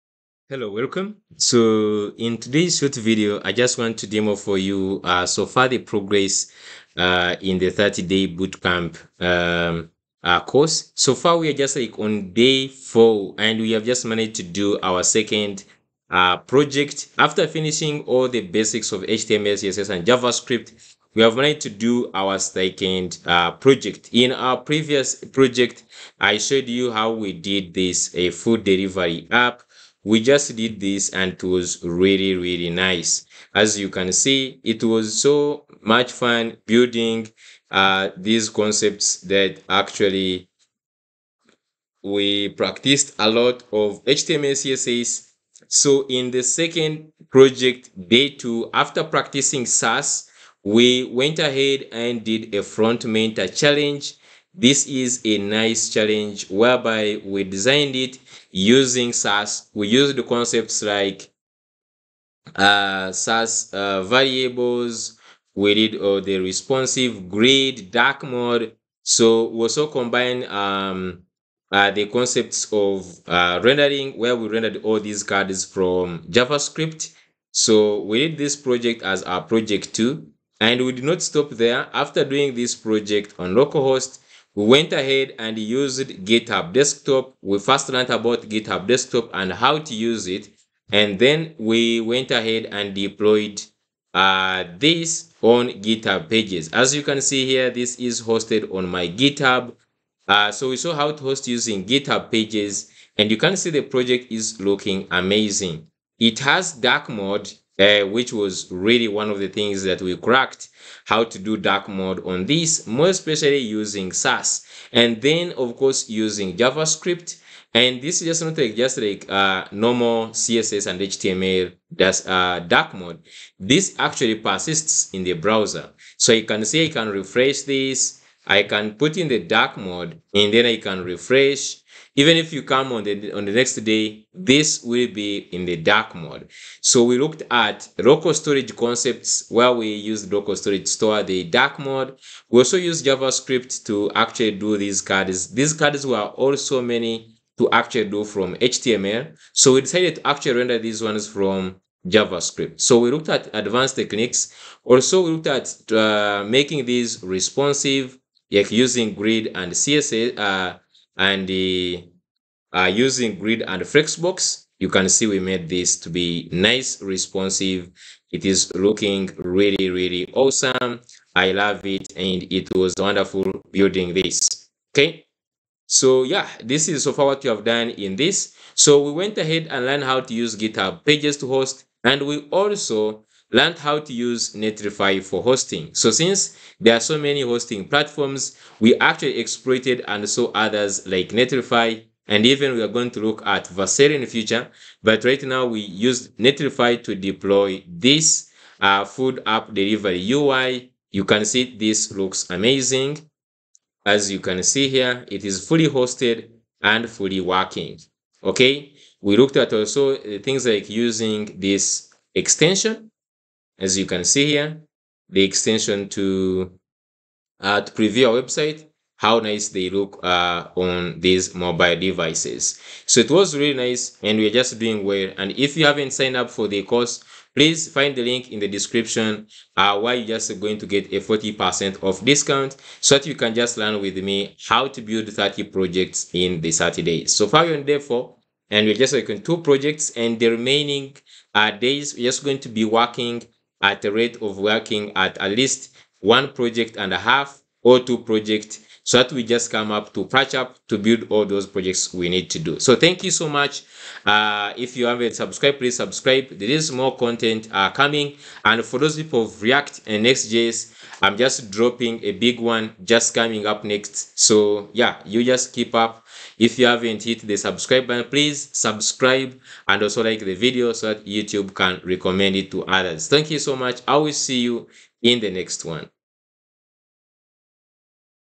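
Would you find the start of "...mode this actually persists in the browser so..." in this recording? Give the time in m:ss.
2:02.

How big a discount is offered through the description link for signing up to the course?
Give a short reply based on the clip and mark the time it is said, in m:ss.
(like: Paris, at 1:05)
40%, at 3:51.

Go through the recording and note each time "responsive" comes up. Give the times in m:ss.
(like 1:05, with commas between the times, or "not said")
1:06, 2:37, 2:47.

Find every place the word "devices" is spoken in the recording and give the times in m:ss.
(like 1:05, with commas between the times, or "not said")
3:41.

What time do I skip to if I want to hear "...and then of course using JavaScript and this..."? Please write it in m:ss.
1:54.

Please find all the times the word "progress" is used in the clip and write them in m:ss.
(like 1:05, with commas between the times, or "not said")
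0:05.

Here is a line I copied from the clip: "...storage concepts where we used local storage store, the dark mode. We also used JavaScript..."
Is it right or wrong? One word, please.
right.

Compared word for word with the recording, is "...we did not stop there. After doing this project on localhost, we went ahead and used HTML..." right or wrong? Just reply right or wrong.
wrong.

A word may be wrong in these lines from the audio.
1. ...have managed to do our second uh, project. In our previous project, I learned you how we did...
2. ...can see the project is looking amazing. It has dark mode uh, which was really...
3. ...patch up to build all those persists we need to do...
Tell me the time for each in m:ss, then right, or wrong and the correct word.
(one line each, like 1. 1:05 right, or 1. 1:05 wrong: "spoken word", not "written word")
1. 0:21 wrong: "showed", not "learned"
2. 1:43 right
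3. 4:10 wrong: "projects", not "persists".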